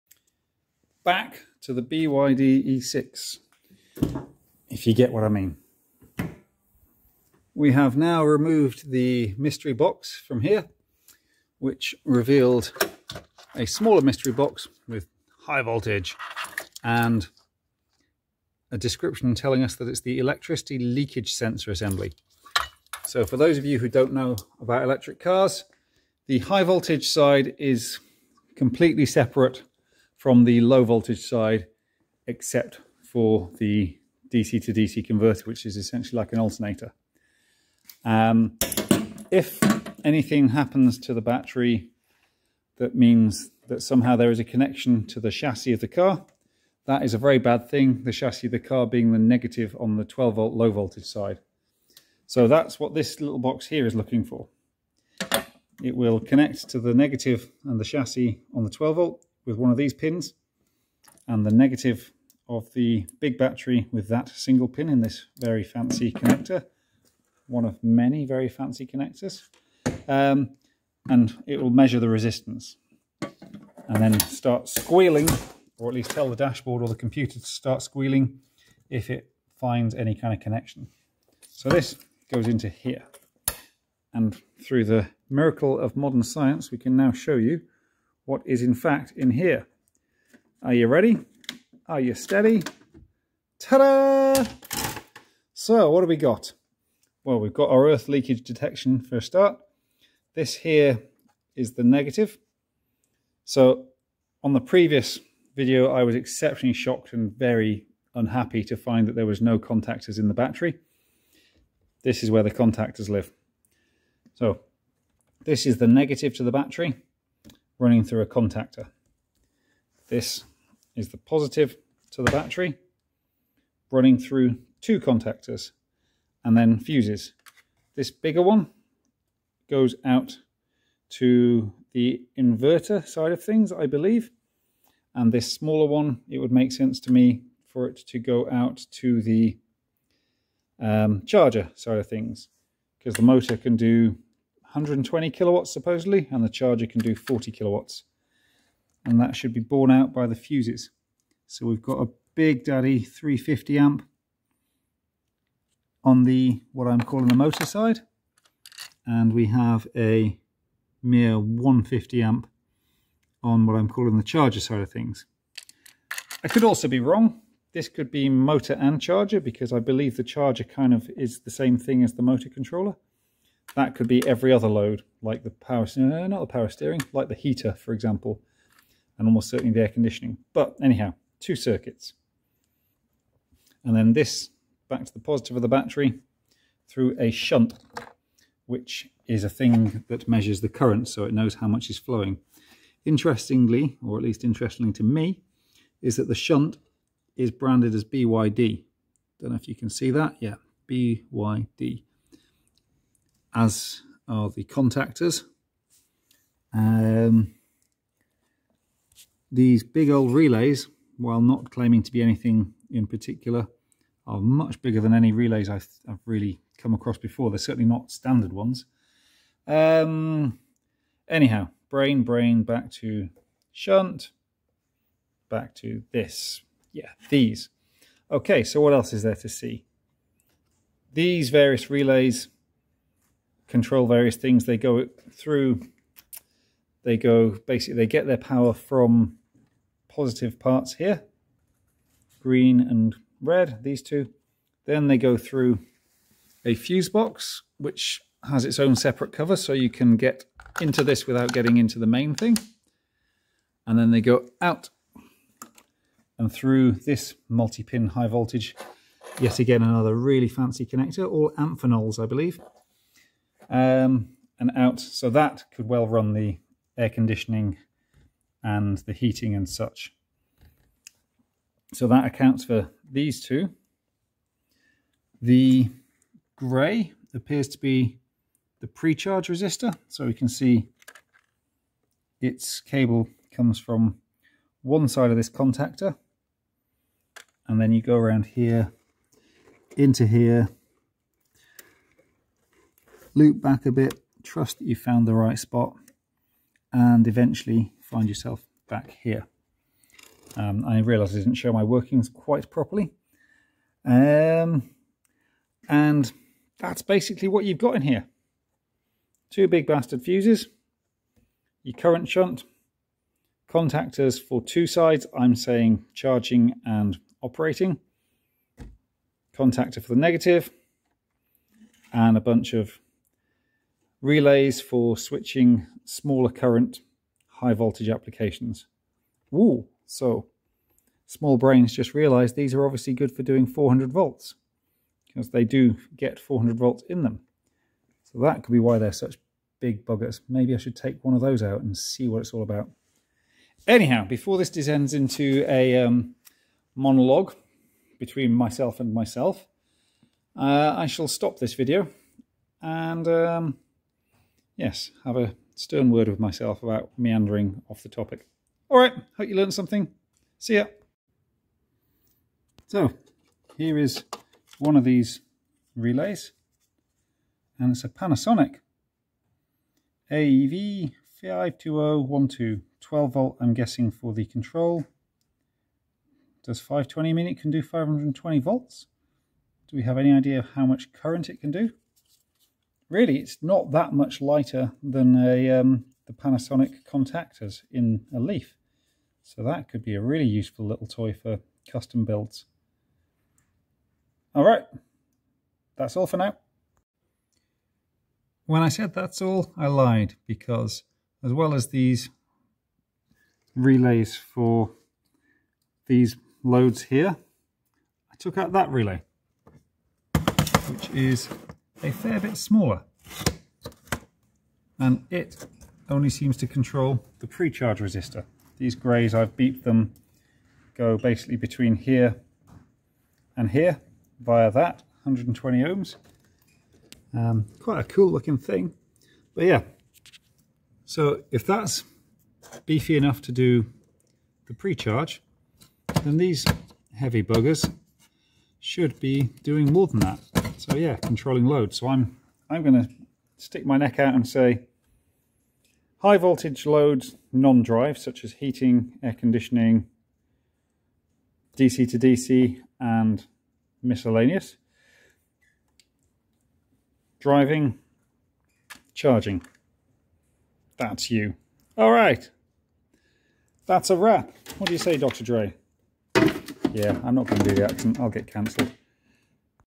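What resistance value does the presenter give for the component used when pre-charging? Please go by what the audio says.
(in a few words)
120 ohms.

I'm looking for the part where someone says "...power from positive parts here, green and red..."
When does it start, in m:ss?
3:58.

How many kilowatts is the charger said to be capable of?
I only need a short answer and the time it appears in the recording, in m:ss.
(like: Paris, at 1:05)
40 kilowatts, at 2:27.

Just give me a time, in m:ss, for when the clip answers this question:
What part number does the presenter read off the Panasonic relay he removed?
6:10.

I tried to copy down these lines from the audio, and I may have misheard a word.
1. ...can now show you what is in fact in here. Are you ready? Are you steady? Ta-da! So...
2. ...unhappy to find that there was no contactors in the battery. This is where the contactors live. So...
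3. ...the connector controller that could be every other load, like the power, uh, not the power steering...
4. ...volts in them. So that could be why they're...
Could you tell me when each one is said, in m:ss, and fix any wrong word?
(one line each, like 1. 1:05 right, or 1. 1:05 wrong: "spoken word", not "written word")
1. 1:26 right
2. 1:48 right
3. 2:52 wrong: "motor", not "connector"
4. 5:36 right.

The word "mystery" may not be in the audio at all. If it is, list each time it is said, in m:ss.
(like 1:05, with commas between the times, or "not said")
0:09, 0:14.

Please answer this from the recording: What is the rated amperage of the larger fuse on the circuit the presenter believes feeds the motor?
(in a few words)
350 amp.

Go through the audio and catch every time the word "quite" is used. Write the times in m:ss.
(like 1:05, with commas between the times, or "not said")
5:02, 7:07.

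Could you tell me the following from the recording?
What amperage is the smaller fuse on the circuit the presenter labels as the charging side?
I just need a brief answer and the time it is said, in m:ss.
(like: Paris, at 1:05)
150 amp, at 2:41.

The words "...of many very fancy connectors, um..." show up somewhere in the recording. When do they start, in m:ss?
1:07.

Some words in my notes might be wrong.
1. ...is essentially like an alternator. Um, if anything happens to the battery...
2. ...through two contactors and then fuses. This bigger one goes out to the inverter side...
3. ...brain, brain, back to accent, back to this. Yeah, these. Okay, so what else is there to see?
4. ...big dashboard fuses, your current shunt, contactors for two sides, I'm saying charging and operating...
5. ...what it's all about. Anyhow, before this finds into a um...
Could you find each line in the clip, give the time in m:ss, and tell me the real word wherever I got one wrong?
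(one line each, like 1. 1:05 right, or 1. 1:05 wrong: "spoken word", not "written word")
1. 0:35 right
2. 2:04 right
3. 3:41 wrong: "shunt", not "accent"
4. 5:09 wrong: "bastard", not "dashboard"
5. 5:42 wrong: "descends", not "finds".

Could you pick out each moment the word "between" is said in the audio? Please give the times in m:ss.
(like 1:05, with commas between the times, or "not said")
5:48, 7:01.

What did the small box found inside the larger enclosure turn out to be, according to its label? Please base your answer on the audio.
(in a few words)
Electricity leakage sensor assembly.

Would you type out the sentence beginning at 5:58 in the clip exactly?
All right, hope you learned something.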